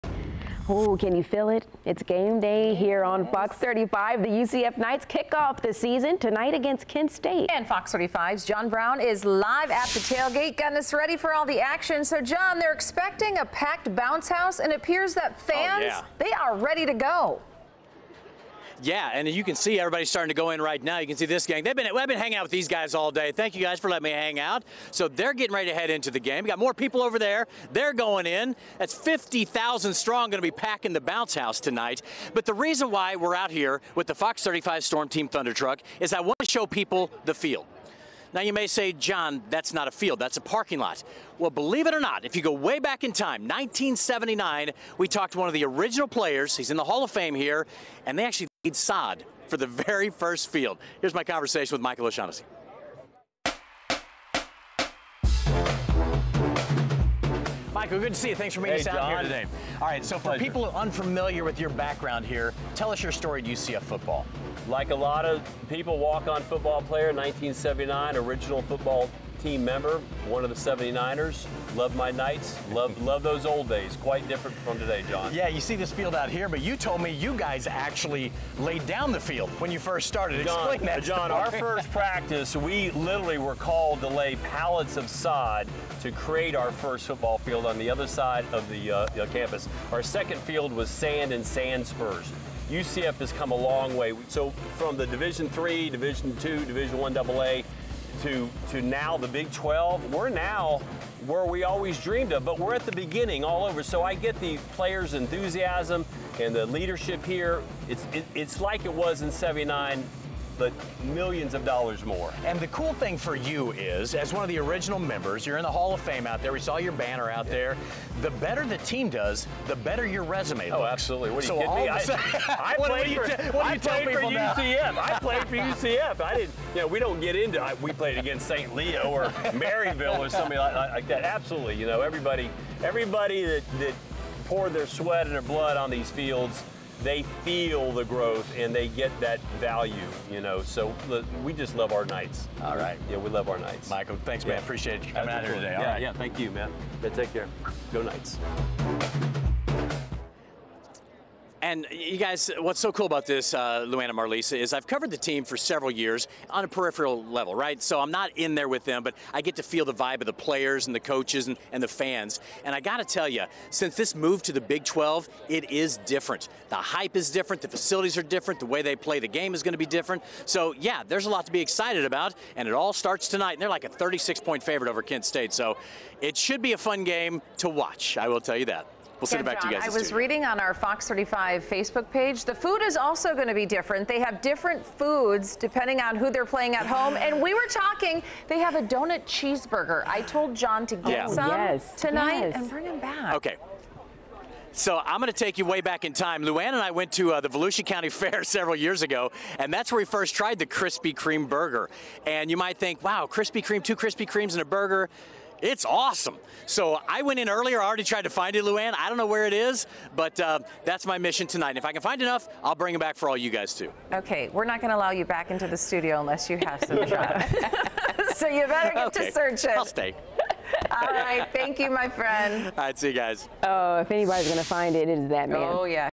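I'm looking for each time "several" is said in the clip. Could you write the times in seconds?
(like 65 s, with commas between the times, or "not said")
155 s, 198 s.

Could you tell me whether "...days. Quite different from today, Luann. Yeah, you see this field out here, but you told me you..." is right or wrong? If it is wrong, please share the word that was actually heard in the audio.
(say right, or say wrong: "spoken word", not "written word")
wrong: "John", not "Luann".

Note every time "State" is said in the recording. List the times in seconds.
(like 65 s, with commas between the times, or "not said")
7 s, 175 s.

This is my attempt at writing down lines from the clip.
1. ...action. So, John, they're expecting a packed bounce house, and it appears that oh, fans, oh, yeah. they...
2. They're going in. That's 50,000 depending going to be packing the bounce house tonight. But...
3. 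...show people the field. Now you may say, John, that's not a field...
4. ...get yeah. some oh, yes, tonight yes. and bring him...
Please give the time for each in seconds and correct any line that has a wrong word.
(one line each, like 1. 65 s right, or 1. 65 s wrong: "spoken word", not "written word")
1. 11 s right
2. 27 s wrong: "strong", not "depending"
3. 36 s right
4. 190 s right.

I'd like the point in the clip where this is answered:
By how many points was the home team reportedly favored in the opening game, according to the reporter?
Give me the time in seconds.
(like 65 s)
173 s.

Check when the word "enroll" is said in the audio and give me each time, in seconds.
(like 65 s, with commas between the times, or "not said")
not said.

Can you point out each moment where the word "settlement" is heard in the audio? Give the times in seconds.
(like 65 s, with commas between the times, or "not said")
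not said.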